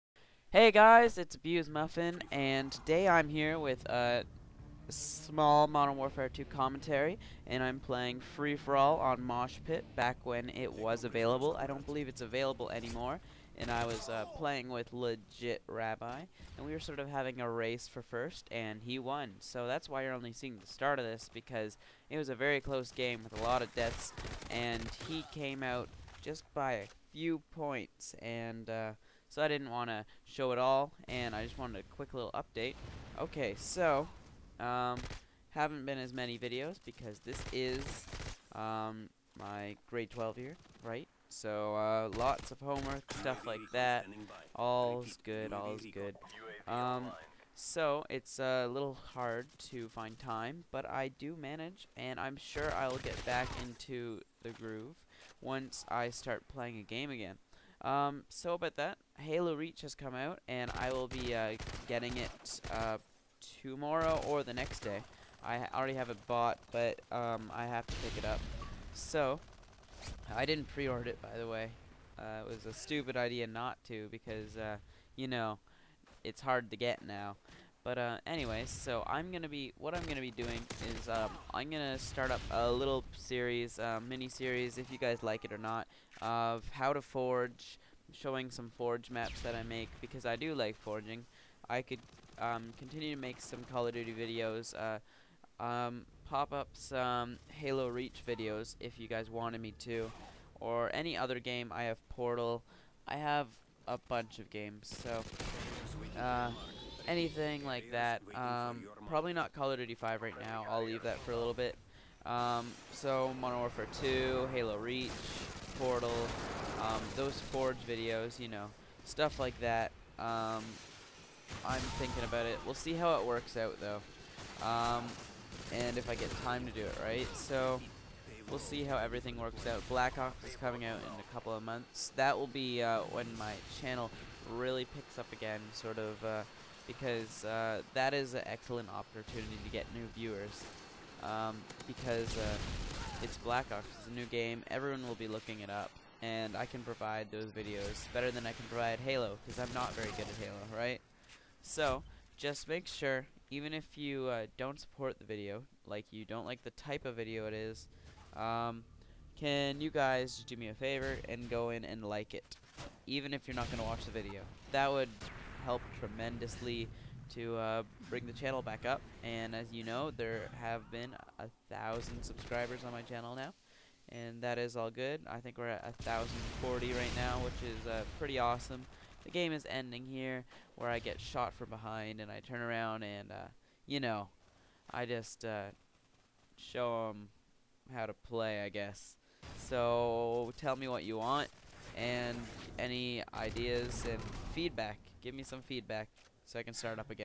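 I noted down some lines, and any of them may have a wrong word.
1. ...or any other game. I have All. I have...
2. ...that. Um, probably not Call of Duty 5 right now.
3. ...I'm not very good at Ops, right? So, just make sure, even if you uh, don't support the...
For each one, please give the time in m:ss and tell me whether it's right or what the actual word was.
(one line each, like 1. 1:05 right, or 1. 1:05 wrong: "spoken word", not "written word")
1. 1:40 wrong: "Portal", not "All"
2. 1:47 right
3. 2:29 wrong: "Halo", not "Ops".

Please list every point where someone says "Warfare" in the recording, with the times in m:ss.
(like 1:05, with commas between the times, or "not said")
0:05, 1:53.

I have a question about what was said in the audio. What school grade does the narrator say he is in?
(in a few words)
Grade 12.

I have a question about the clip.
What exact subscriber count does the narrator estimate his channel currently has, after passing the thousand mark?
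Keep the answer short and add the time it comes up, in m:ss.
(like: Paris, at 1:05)
1,040, at 2:56.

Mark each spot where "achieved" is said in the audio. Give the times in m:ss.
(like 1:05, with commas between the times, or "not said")
not said.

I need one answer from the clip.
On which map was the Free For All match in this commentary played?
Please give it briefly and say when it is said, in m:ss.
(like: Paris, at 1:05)
Mosh Pit, at 0:09.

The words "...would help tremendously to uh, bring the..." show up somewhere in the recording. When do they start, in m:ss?
2:44.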